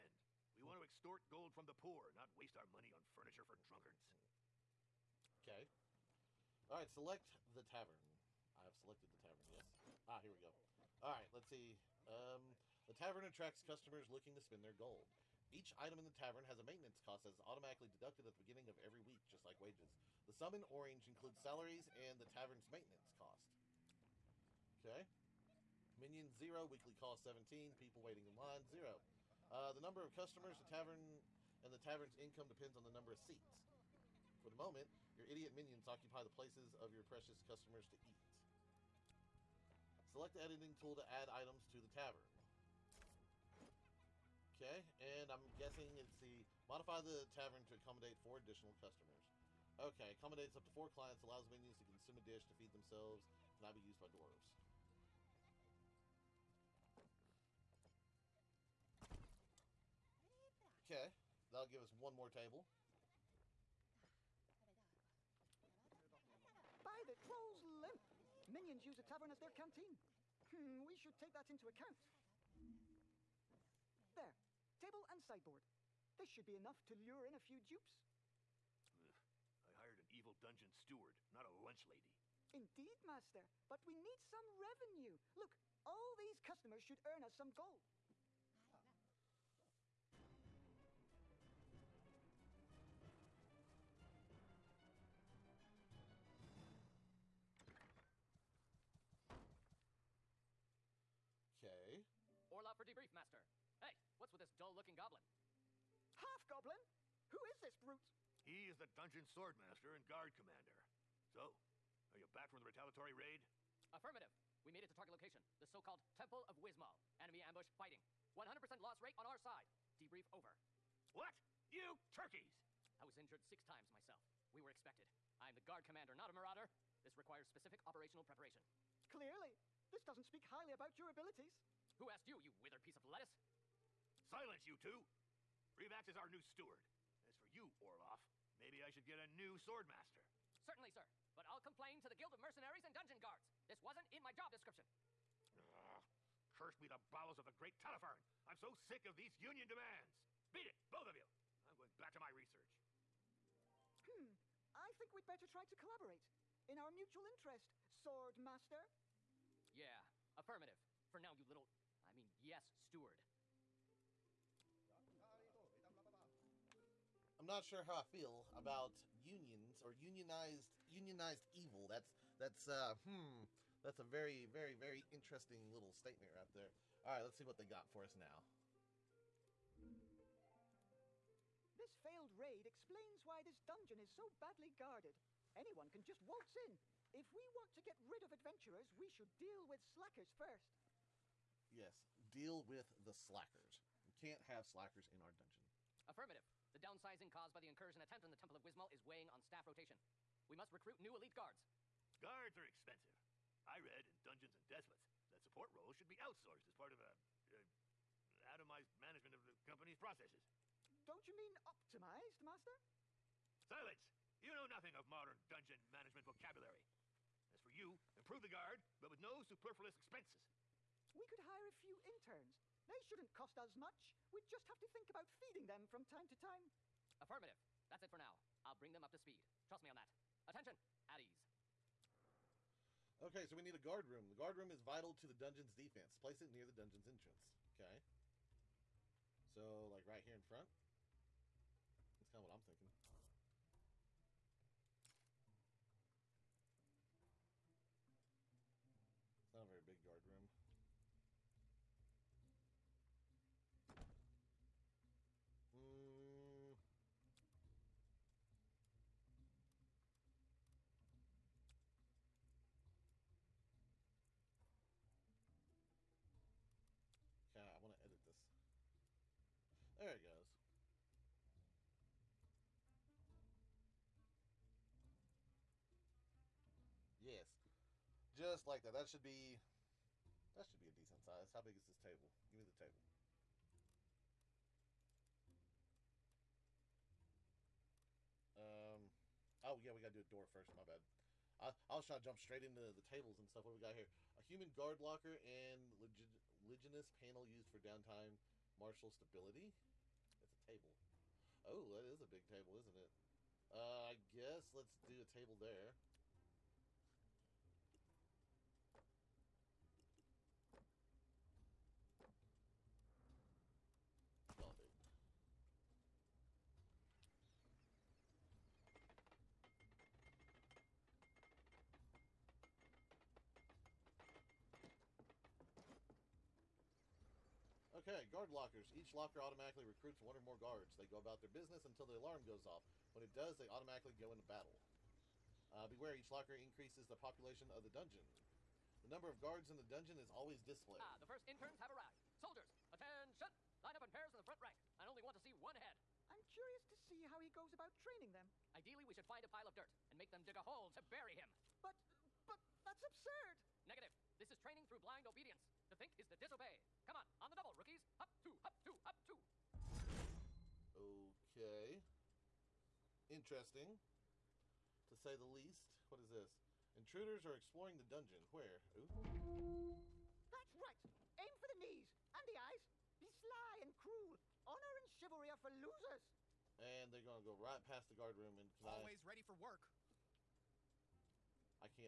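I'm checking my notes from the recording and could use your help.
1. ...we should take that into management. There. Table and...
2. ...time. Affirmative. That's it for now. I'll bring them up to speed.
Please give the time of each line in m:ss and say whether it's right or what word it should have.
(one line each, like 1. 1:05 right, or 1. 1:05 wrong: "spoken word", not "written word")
1. 1:10 wrong: "account", not "management"
2. 3:46 right.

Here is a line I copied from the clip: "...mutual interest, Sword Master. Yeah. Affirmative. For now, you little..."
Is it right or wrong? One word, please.
right.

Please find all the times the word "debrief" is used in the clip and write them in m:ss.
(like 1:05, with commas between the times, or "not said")
1:42, 1:59.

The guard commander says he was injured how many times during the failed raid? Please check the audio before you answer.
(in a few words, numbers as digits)
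6.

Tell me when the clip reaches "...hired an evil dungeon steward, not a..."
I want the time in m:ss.
1:19.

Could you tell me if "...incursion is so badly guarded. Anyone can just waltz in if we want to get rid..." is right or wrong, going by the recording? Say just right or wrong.
wrong.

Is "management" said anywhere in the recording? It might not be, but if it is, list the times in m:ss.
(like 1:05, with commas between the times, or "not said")
3:28, 3:35.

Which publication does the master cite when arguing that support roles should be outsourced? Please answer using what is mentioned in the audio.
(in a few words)
Dungeons and Despots.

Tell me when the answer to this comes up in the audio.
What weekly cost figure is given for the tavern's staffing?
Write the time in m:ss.
0:26.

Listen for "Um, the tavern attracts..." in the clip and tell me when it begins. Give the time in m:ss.
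0:12.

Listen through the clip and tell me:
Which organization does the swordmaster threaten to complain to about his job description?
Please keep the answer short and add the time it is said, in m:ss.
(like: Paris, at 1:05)
Guild of Mercenaries and Dungeon Guards, at 2:22.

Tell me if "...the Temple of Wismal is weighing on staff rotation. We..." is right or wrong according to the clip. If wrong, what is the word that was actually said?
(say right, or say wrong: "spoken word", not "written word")
right.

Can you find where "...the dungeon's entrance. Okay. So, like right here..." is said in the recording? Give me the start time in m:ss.
3:56.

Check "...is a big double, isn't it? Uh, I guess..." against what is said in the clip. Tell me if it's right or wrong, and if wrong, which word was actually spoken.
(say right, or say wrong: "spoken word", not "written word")
wrong: "table", not "double".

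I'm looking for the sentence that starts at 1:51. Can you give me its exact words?
So, are you back from the retaliatory raid?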